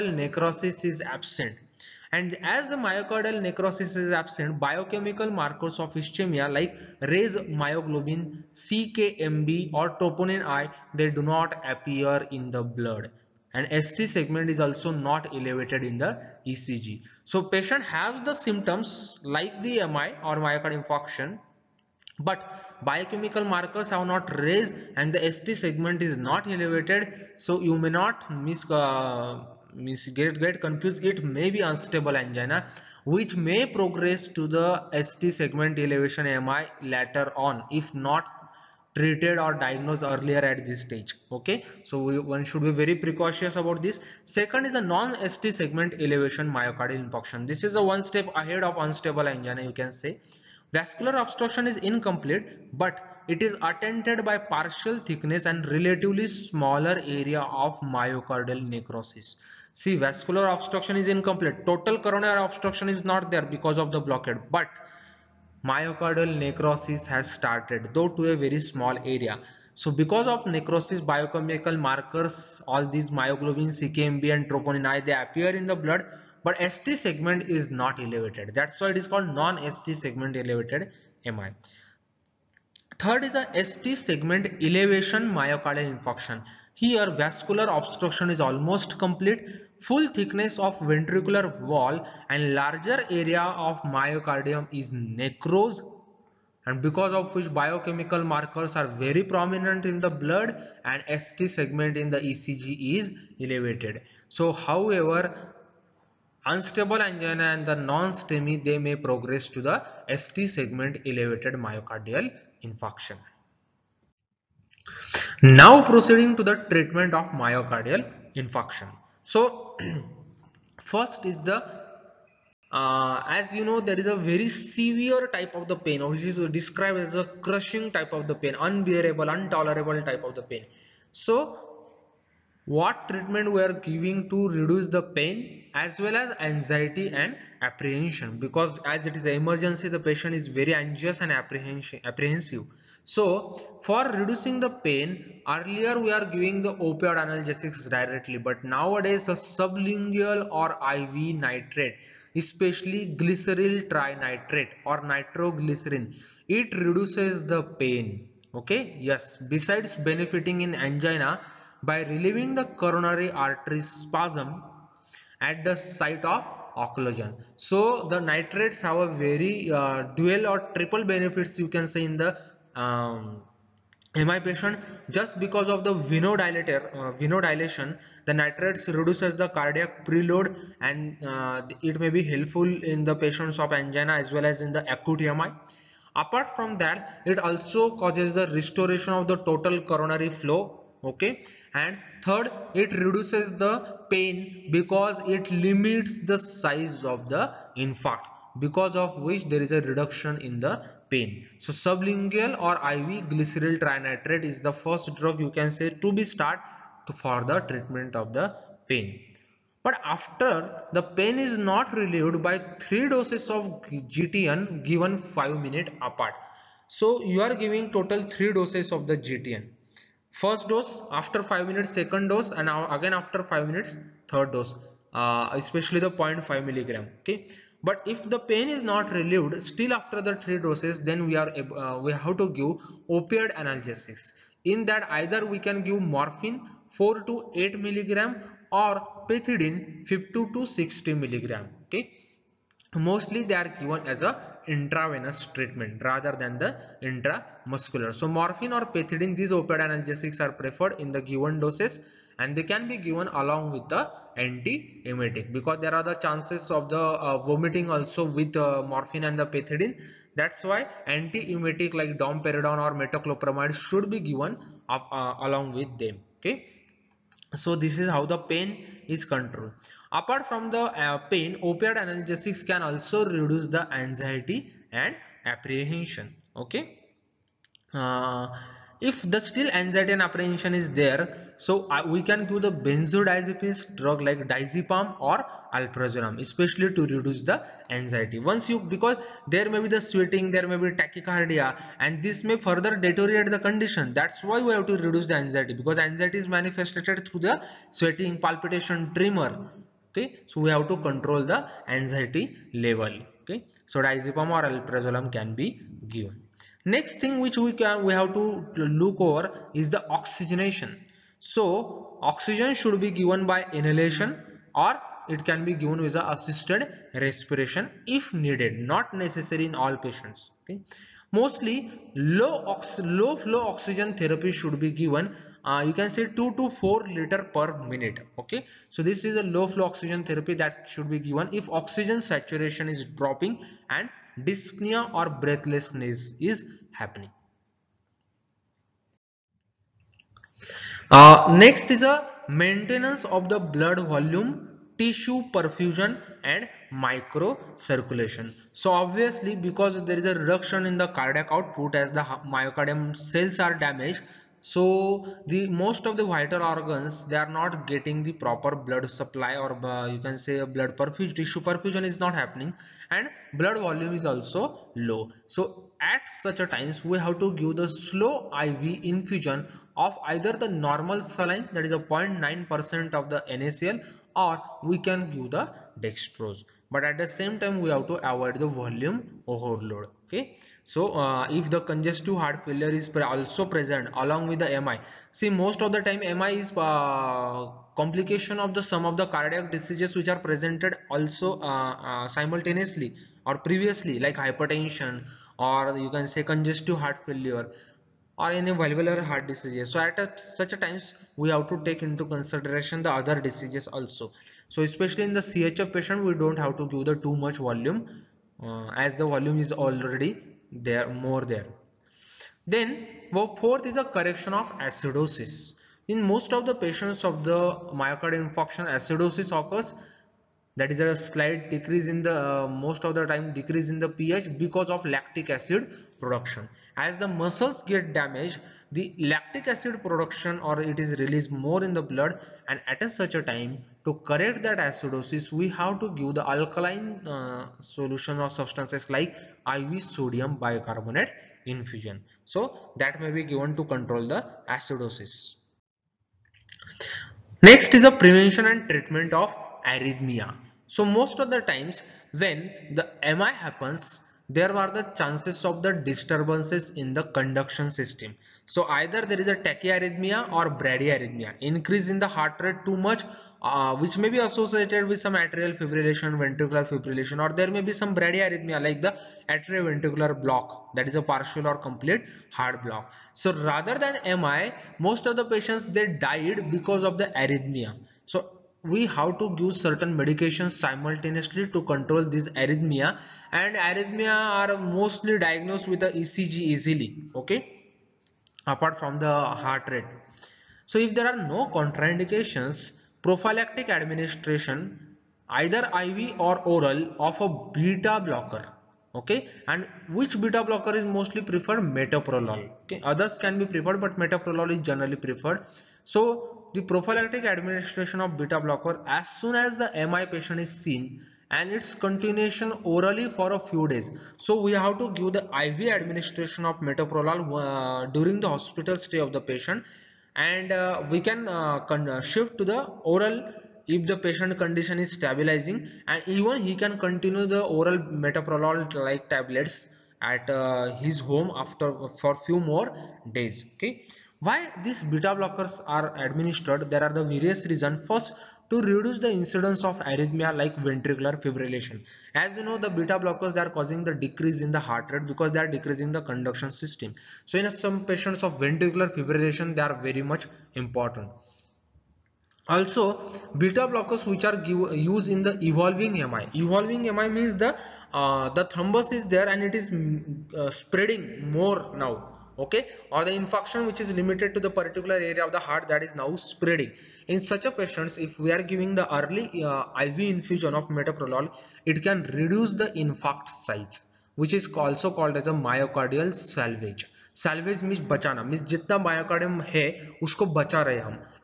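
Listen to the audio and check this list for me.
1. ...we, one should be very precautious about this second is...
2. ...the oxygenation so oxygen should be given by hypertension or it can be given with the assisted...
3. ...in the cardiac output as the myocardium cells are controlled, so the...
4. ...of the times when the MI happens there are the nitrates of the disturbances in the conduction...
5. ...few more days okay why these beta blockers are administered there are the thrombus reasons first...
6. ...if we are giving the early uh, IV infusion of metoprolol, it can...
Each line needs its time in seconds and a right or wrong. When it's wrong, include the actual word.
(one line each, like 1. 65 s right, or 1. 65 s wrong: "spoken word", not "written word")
1. 42 s right
2. 309 s wrong: "inhalation", not "hypertension"
3. 350 s wrong: "damaged", not "controlled"
4. 451 s wrong: "chances", not "nitrates"
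5. 532 s wrong: "various", not "thrombus"
6. 568 s right.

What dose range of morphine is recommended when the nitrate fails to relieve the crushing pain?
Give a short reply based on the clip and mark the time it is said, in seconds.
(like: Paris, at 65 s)
4 to 8 milligram, at 236 s.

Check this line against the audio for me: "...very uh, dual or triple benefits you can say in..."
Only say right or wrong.
right.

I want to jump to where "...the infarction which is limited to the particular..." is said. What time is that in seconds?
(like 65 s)
563 s.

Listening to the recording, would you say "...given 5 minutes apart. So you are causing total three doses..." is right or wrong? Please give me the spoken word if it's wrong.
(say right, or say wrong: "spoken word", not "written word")
wrong: "giving", not "causing".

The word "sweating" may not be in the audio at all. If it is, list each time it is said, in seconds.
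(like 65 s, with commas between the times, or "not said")
290 s, 297 s.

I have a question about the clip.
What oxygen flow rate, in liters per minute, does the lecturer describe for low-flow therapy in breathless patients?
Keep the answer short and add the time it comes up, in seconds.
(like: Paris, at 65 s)
2 to 4 liters per minute, at 326 s.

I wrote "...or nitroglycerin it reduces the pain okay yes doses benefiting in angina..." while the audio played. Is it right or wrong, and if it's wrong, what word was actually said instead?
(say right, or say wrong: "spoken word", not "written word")
wrong: "besides", not "doses".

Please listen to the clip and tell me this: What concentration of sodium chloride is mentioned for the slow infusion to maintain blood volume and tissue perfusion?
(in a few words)
0.9 percent.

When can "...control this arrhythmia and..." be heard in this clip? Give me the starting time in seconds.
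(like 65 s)
481 s.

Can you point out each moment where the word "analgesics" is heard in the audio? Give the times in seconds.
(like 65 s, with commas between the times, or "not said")
147 s, 233 s, 249 s, 271 s.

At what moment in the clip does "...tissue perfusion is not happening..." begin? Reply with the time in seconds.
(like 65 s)
361 s.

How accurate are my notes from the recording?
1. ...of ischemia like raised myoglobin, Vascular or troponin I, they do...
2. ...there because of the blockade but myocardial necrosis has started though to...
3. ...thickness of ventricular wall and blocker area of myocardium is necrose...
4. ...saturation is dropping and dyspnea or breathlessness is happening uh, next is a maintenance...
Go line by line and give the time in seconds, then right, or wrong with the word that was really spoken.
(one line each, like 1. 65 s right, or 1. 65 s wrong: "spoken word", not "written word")
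1. 5 s wrong: "CKMB", not "Vascular"
2. 63 s right
3. 90 s wrong: "larger", not "blocker"
4. 332 s right.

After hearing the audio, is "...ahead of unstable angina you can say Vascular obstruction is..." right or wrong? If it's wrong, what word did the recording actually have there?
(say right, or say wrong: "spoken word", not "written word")
right.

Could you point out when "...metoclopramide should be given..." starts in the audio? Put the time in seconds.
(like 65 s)
262 s.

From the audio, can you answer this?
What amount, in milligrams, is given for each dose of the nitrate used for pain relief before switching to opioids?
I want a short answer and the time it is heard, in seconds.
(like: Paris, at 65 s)
0.5 milligram, at 226 s.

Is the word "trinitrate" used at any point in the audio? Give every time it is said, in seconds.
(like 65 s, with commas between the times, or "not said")
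153 s, 203 s.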